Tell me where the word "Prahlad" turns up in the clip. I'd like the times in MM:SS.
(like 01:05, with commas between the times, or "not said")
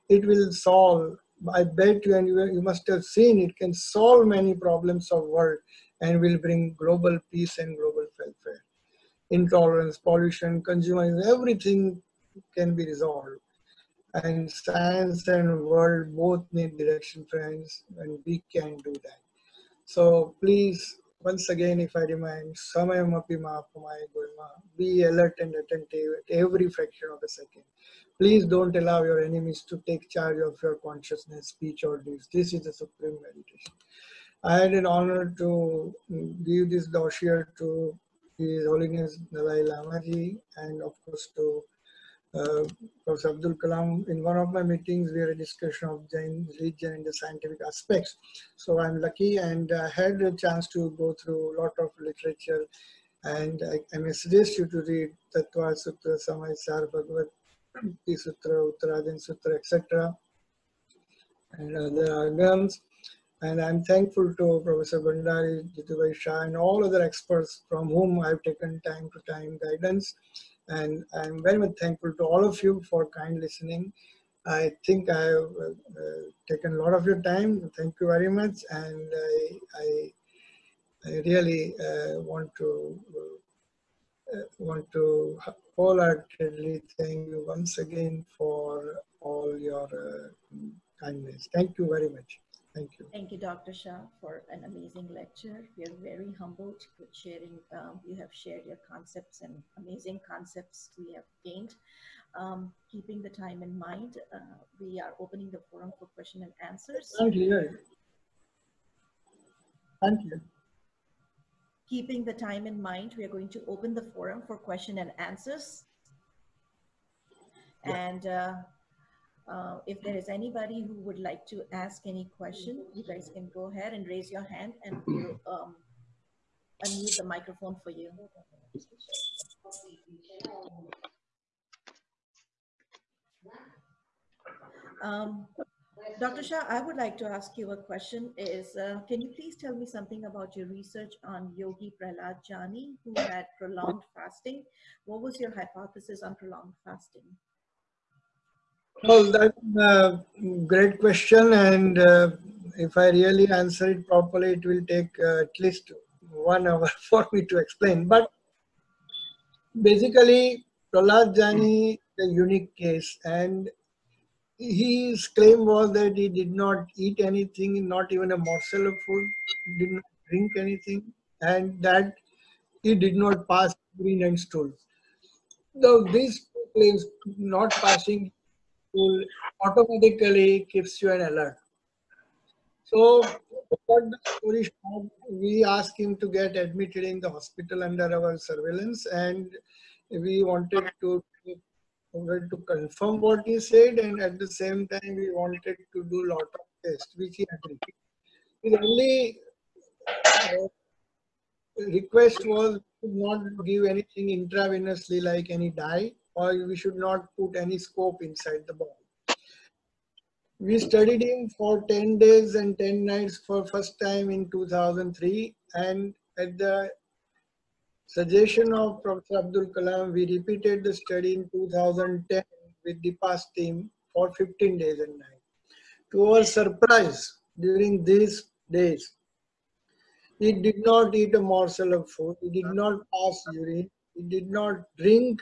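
02:22, 02:40.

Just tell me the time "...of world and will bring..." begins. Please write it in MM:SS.
00:05.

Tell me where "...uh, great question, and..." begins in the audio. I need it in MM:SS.
02:29.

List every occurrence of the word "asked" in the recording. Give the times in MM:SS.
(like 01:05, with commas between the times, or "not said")
03:05.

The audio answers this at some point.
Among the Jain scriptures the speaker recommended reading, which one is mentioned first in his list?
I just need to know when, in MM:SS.
00:55.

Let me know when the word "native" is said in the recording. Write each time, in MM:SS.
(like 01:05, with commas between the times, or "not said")
not said.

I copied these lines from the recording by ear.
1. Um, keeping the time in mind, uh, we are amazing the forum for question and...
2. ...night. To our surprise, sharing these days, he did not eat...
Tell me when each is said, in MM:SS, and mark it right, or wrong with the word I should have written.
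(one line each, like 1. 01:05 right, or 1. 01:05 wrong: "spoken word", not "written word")
1. 01:42 wrong: "opening", not "amazing"
2. 03:45 wrong: "during", not "sharing".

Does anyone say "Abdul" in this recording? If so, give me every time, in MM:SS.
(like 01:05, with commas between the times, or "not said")
00:43, 03:39.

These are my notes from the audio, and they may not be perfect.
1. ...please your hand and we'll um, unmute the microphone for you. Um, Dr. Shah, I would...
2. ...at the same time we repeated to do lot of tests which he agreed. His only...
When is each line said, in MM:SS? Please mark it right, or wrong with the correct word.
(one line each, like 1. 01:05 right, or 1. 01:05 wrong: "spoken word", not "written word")
1. 02:04 wrong: "raise", not "please"
2. 03:14 wrong: "wanted", not "repeated".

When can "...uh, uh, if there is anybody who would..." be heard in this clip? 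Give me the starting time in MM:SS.
01:58.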